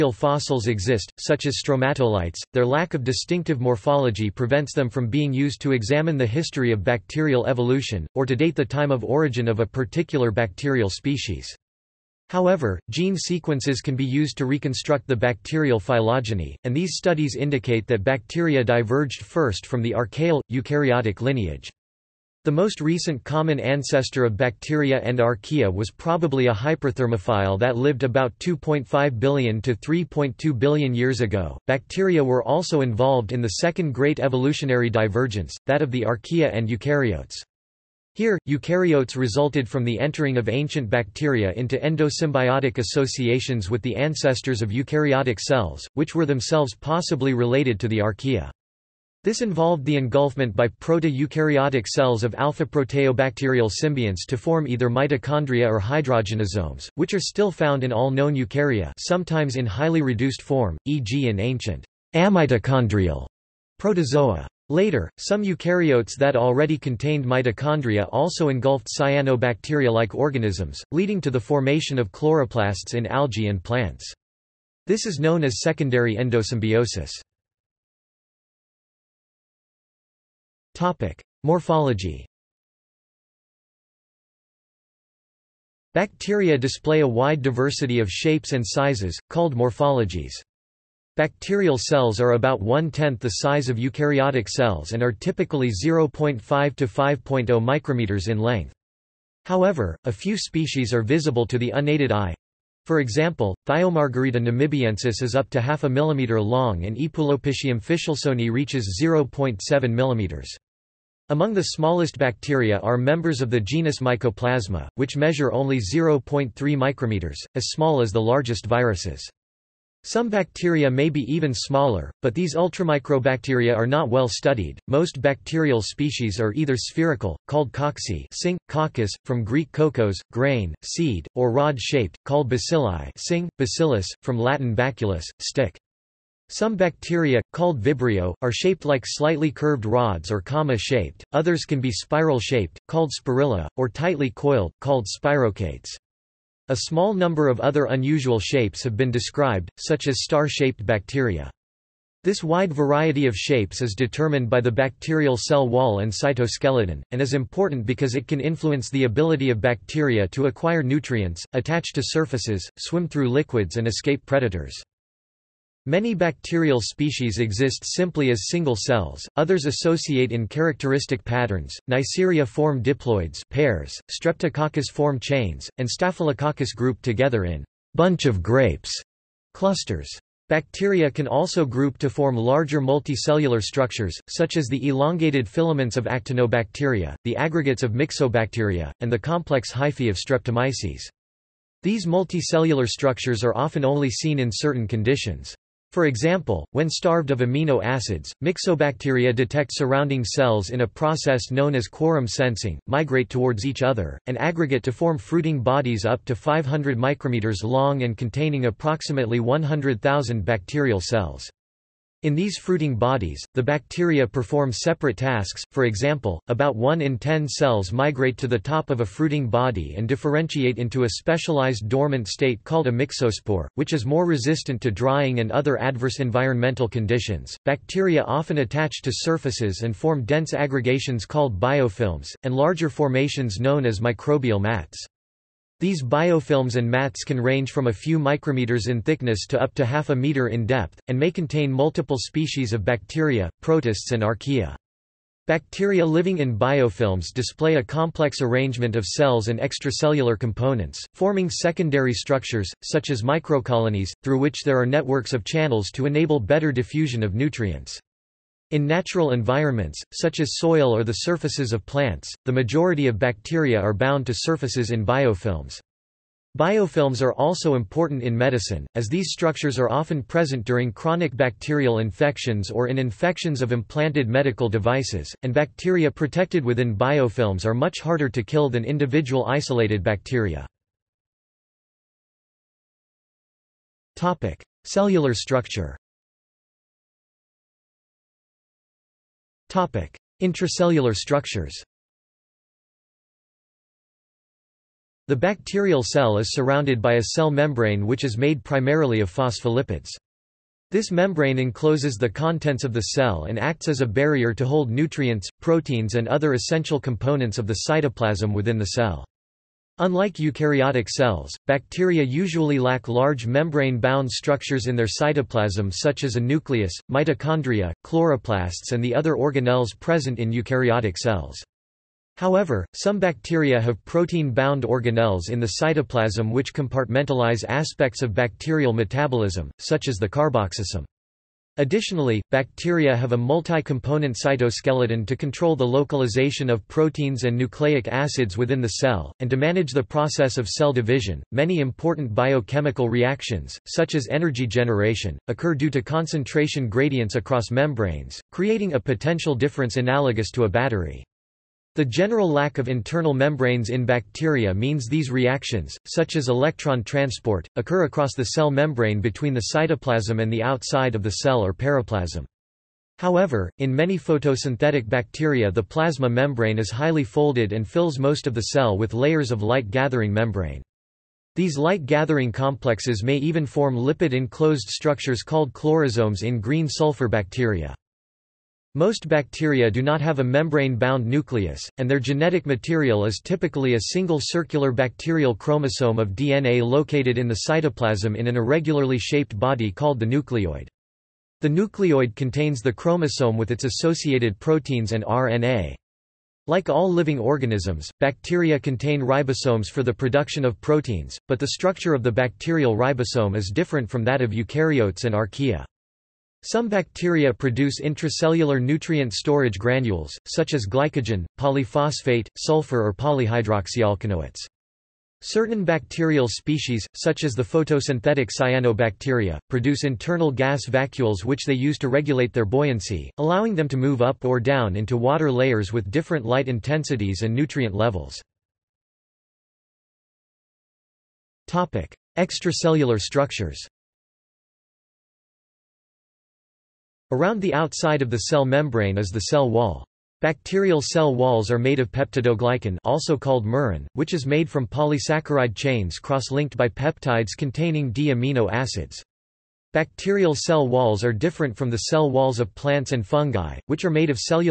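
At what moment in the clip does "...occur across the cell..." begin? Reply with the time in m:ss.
5:57.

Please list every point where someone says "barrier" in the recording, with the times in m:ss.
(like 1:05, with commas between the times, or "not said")
5:04.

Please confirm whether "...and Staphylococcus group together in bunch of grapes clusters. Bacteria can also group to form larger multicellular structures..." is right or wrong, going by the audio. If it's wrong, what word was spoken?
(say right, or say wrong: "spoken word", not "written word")
right.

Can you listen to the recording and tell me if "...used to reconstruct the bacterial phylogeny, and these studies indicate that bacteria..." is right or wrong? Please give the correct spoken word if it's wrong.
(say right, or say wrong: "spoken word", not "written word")
right.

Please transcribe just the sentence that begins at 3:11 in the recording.
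These multicellular structures are often only seen in certain conditions.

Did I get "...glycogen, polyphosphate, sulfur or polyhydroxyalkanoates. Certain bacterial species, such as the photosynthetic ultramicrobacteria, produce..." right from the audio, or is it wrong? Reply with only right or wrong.
wrong.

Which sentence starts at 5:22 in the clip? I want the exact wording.
However, some bacteria have protein-bound organelles in the cytoplasm which compartmentalize aspects of bacterial metabolism, such as the carboxysome.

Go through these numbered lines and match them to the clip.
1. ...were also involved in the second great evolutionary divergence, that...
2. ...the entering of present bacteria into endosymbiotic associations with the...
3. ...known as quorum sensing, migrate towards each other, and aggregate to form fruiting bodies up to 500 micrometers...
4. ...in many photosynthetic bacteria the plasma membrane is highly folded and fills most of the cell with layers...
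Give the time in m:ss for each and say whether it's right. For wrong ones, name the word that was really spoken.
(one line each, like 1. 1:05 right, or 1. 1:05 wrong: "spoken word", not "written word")
1. 0:32 right
2. 0:39 wrong: "ancient", not "present"
3. 3:21 right
4. 6:03 right.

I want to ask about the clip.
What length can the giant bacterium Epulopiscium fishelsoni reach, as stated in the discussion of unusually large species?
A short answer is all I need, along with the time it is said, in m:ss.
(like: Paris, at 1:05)
0.7 millimeters, at 1:49.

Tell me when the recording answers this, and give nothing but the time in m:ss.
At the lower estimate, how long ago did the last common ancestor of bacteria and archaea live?
0:28.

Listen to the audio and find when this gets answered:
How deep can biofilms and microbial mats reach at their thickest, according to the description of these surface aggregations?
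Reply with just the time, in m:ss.
3:59.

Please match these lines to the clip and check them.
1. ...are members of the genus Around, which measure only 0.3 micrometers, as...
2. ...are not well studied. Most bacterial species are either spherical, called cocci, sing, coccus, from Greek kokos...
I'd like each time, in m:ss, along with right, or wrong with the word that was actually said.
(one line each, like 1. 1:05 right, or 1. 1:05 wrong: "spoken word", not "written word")
1. 1:52 wrong: "Mycoplasma", not "Around"
2. 2:03 right.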